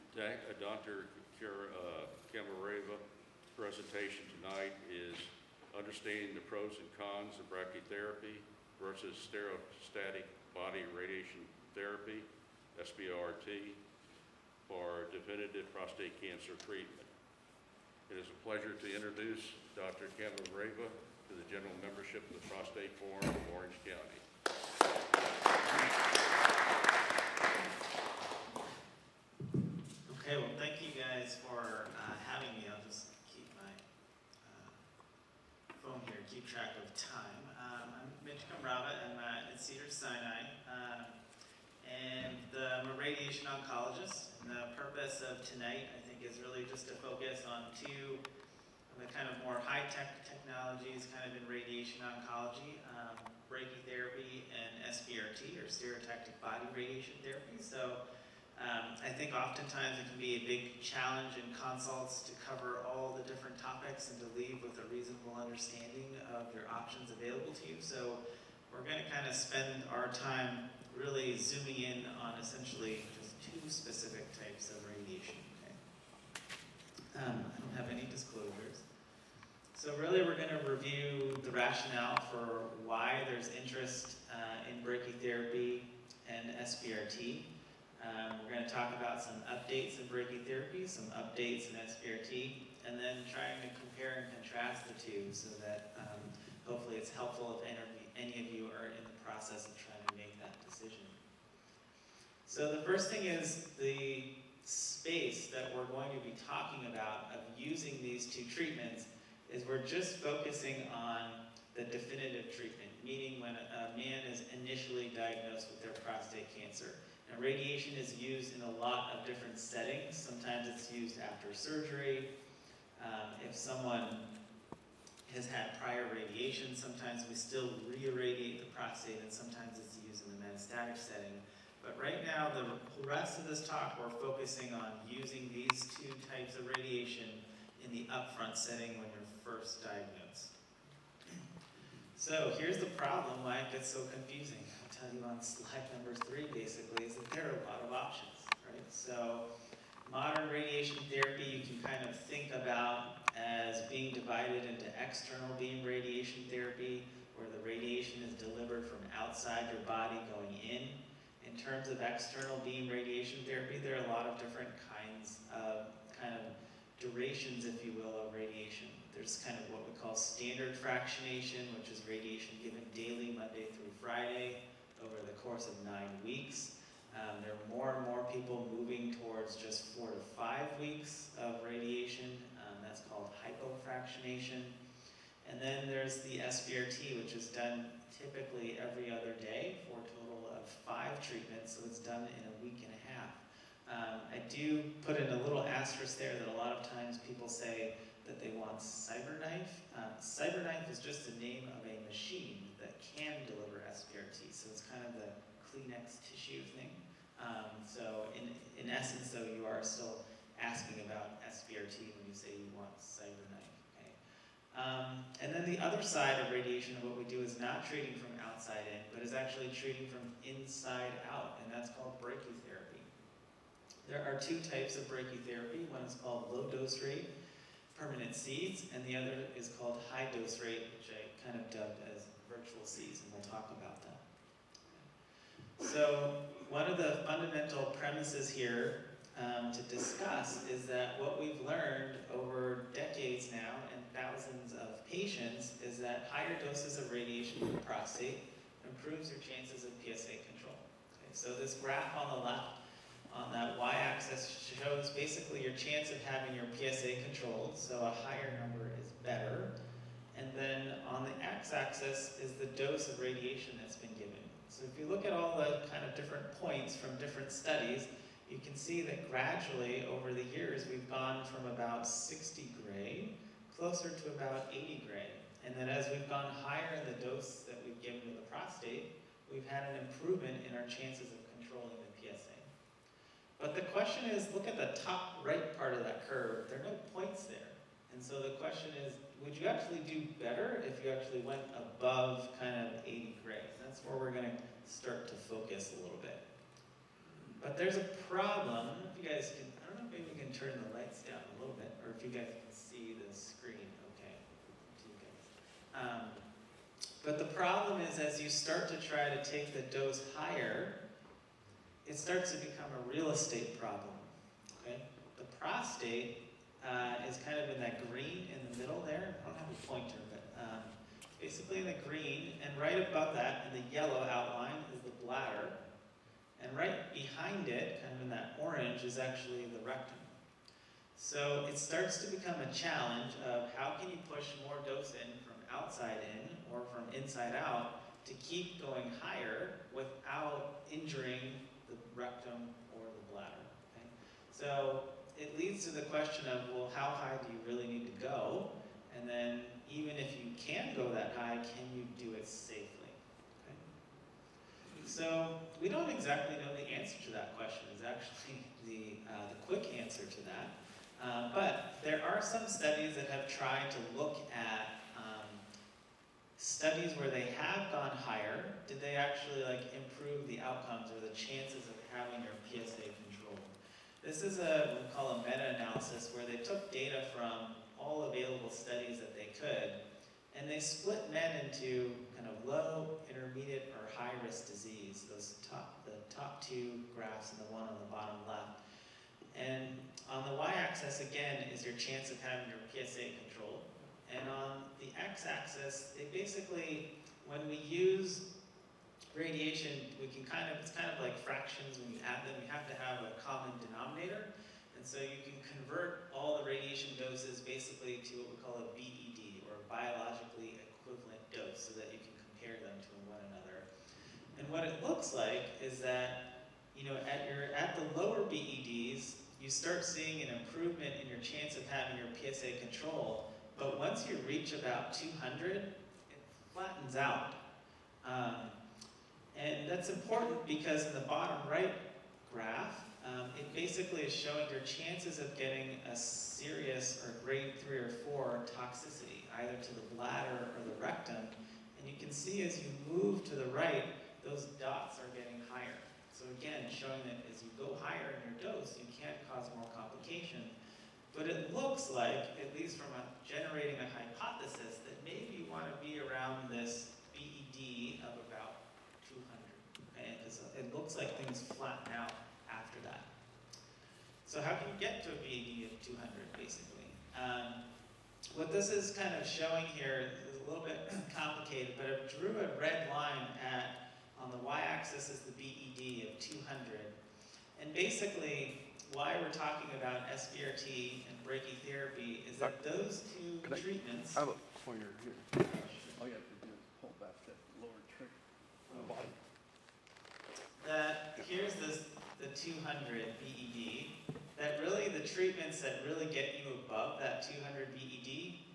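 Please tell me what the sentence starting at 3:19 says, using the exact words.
Um, CyberKnife is just the name of a machine that can deliver SBRT, so it's kind of the Kleenex tissue thing.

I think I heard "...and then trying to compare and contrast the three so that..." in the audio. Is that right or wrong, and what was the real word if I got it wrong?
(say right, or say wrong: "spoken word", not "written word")
wrong: "two", not "three".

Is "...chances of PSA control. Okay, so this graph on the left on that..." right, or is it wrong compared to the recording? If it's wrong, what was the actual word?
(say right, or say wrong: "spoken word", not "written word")
right.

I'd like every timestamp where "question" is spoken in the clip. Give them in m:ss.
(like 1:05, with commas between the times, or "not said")
4:43, 4:48, 5:46, 5:57.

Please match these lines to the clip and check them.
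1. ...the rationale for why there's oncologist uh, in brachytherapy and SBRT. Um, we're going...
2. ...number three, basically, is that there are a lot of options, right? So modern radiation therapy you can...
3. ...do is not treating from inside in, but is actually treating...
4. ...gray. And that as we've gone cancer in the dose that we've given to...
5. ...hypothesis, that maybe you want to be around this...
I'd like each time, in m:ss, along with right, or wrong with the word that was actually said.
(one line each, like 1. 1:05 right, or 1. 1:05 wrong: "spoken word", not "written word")
1. 1:21 wrong: "interest", not "oncologist"
2. 2:25 right
3. 3:37 wrong: "outside", not "inside"
4. 4:35 wrong: "higher", not "cancer"
5. 7:34 right.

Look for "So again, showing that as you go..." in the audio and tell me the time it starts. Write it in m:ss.
7:26.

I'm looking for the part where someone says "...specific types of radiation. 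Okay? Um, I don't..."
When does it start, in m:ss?
1:13.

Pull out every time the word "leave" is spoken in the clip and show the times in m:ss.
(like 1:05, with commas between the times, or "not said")
1:04.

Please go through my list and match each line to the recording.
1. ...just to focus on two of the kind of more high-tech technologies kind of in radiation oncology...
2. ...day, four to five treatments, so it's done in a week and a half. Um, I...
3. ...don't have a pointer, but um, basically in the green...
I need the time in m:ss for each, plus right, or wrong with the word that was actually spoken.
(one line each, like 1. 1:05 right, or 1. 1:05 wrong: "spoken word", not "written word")
1. 0:46 right
2. 3:09 right
3. 5:19 right.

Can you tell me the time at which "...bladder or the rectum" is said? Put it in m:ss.
7:20.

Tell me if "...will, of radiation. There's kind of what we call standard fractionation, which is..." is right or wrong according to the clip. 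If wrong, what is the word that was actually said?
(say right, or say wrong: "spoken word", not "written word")
right.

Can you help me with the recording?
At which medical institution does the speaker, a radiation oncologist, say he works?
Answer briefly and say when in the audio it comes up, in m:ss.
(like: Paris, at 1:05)
Cedars Sinai, at 0:39.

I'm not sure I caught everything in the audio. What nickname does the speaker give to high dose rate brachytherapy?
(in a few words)
virtual seeds.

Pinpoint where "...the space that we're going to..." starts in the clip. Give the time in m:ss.
1:43.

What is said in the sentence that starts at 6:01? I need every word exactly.
Uh, but there are some studies that have tried to look at um, studies where they have gone higher.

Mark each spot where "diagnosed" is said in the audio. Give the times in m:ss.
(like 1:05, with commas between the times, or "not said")
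1:55, 2:19.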